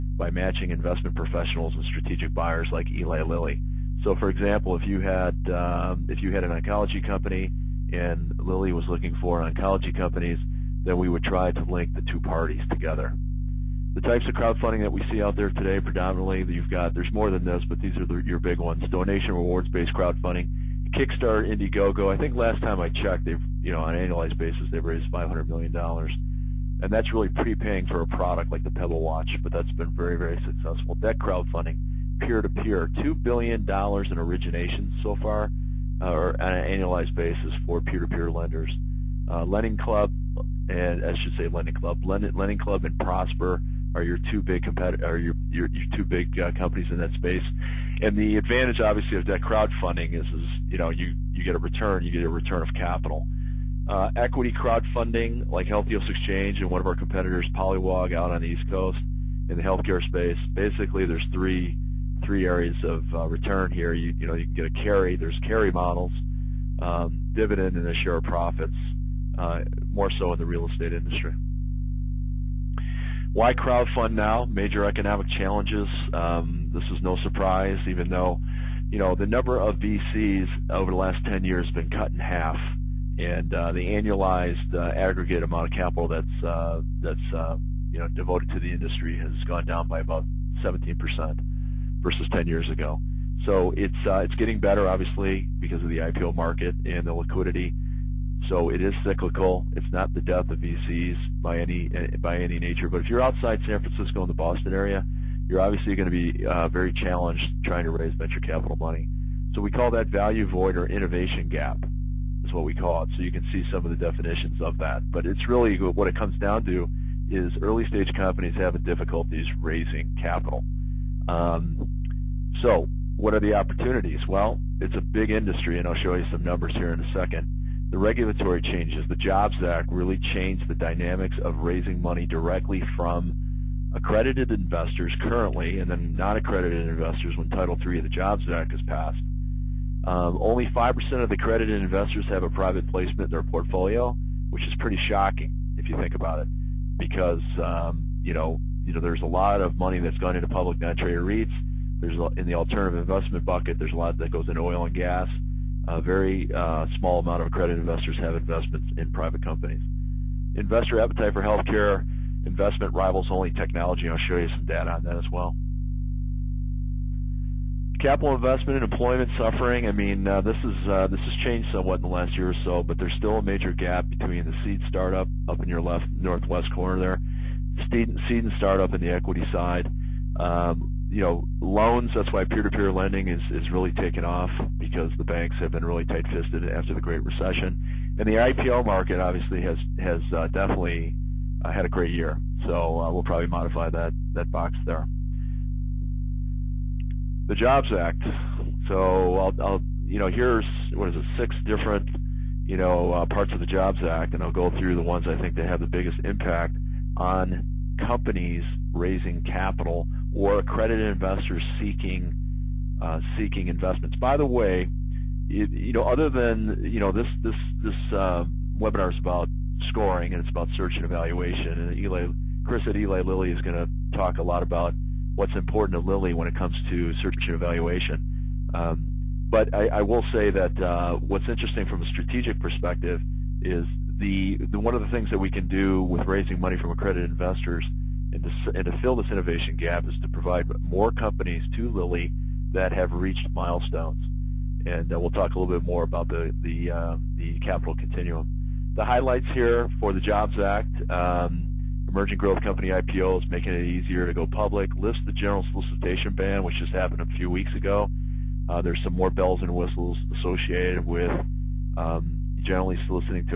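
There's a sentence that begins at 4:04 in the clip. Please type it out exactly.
And uh, we'll talk a little bit more about the, the, uh, the capital continuum.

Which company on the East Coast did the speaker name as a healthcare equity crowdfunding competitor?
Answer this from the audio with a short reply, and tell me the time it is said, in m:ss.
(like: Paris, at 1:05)
Polywog, at 0:57.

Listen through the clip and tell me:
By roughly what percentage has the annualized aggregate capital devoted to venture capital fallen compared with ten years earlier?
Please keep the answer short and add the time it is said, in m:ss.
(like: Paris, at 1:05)
17 percent, at 1:30.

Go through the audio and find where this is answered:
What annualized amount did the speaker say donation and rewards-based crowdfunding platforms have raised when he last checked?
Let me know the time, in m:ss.
0:25.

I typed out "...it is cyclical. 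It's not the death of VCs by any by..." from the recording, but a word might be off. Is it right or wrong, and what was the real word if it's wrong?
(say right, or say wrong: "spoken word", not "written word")
right.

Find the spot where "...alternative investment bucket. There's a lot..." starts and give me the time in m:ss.
2:32.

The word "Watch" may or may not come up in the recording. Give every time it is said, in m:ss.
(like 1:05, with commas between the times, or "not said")
0:29.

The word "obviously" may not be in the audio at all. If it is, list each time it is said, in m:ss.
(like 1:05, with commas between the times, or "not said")
0:48, 1:34, 1:45, 3:09.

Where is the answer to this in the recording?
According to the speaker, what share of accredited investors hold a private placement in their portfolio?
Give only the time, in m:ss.
2:20.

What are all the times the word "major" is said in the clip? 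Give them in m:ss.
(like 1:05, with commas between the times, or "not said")
1:14, 2:53.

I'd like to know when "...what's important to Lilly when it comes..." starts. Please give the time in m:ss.
3:45.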